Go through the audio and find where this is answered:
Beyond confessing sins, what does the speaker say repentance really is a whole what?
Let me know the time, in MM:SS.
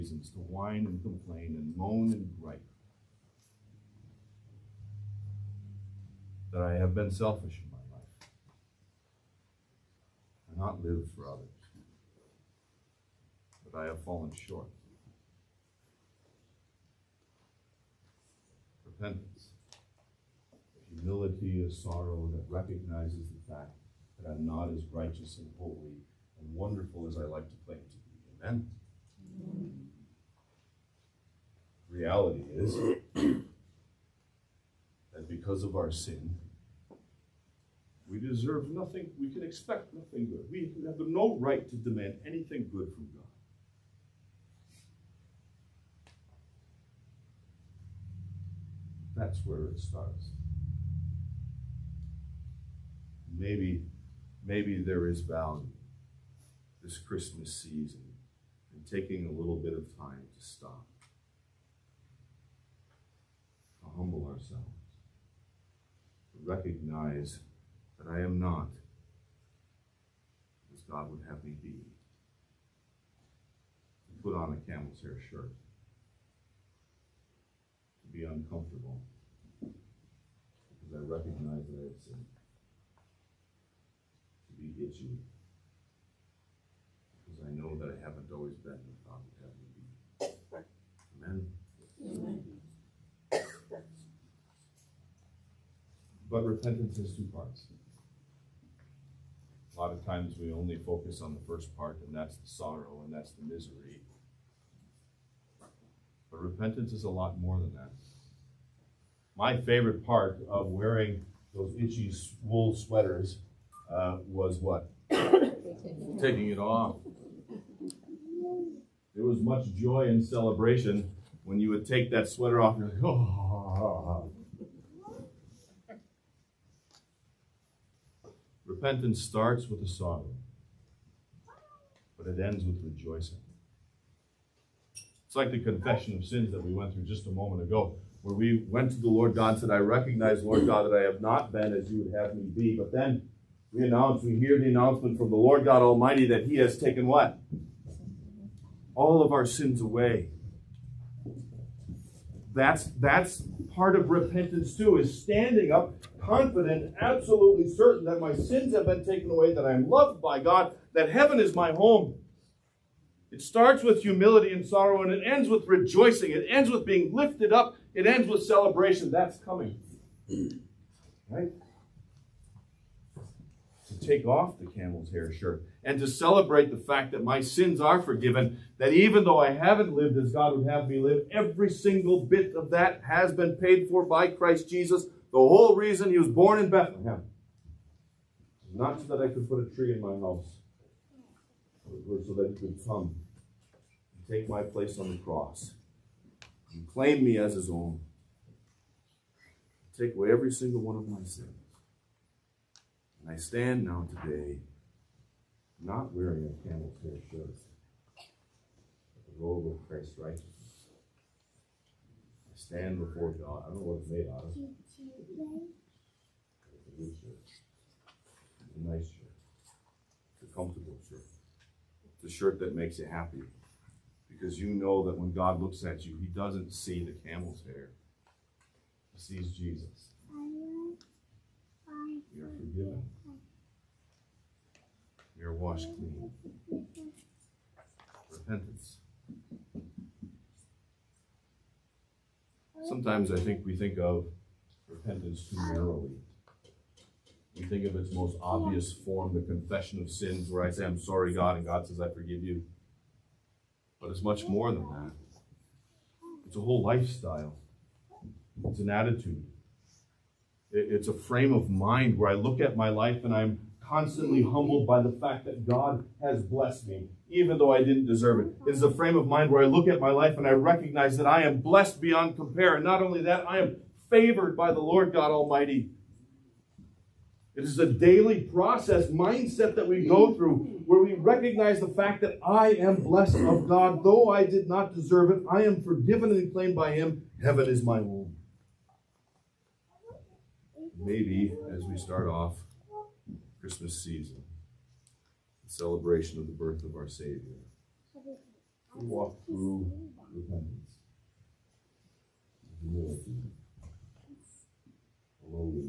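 04:16.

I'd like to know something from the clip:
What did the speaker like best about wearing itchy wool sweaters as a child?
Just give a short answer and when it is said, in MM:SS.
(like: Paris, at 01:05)
Taking it off, at 01:55.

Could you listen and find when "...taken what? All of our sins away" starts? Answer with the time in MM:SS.
02:26.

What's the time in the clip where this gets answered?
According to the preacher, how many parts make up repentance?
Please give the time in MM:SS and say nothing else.
01:37.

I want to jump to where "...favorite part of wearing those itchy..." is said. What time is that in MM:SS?
01:49.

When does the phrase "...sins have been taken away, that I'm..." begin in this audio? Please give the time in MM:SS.
02:38.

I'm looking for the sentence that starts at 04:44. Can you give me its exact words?
Though I did not deserve it, I am forgiven and claimed by Him.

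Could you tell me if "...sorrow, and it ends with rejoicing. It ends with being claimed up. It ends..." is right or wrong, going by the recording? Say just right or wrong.
wrong.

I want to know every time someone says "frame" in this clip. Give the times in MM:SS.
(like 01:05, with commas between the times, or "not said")
04:21, 04:28.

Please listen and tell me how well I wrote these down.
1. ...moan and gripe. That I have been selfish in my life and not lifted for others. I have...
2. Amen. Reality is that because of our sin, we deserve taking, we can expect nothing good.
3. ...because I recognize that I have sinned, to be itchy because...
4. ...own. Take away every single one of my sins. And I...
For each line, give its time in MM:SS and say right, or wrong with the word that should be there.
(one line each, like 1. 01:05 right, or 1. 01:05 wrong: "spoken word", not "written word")
1. 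00:01 wrong: "lived", not "lifted"
2. 00:29 wrong: "nothing", not "taking"
3. 01:19 right
4. 03:17 right.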